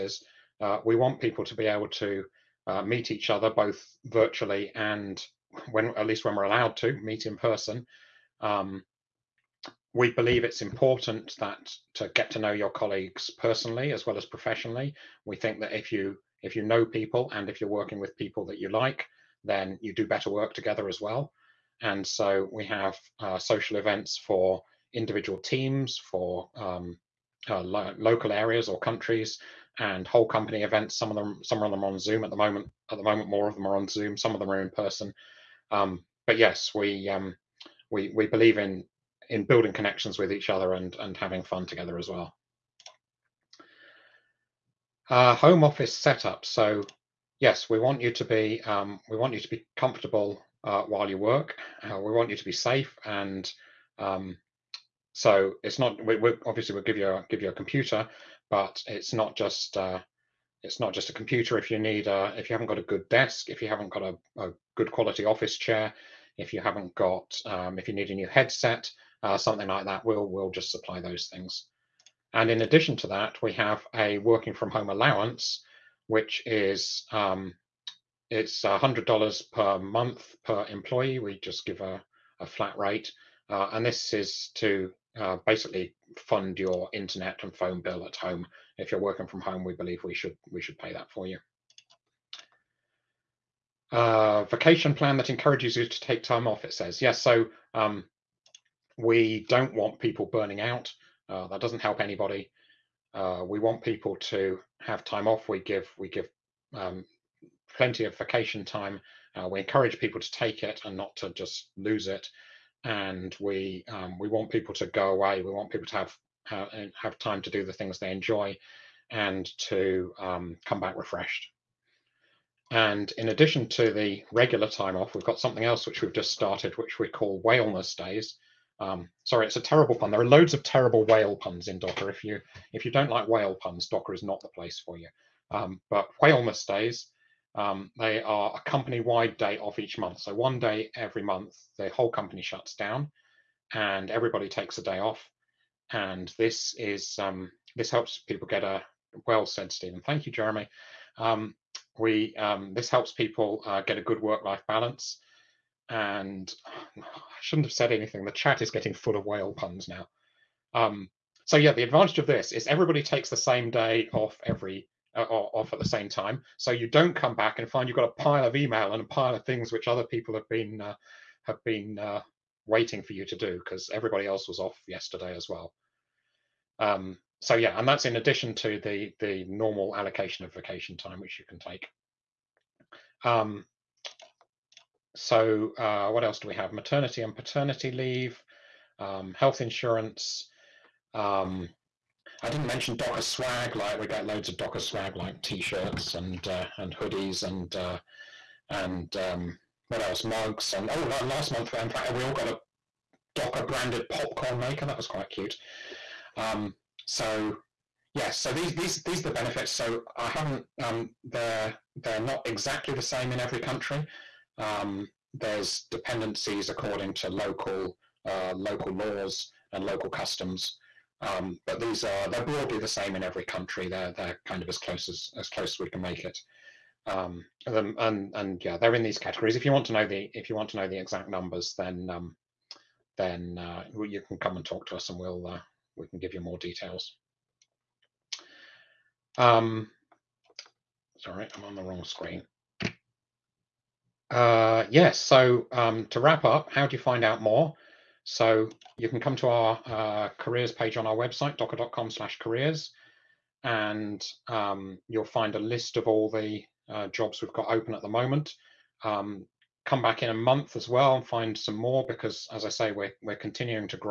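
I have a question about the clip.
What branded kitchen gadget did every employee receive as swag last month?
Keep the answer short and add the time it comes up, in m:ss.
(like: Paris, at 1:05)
popcorn maker, at 3:24.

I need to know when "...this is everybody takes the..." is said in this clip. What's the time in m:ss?
2:42.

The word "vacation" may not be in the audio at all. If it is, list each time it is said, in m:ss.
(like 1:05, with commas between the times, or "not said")
1:34, 1:48, 3:00.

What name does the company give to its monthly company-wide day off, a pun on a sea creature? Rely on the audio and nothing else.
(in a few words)
Whaleness days.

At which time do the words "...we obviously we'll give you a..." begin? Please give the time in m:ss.
0:56.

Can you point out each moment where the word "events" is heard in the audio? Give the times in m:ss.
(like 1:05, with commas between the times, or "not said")
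0:23, 0:30.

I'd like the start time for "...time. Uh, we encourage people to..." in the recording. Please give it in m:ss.
1:48.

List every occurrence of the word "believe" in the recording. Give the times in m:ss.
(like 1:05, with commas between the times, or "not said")
0:10, 0:38, 1:29.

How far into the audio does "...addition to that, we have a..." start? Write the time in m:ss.
1:12.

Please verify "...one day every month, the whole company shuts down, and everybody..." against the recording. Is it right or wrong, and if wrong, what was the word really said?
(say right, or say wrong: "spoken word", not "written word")
right.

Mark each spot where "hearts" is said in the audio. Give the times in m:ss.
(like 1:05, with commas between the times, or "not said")
not said.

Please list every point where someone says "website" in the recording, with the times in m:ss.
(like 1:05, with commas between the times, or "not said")
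4:11.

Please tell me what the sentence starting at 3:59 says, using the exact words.
Um, sorry, I'm on the wrong screen.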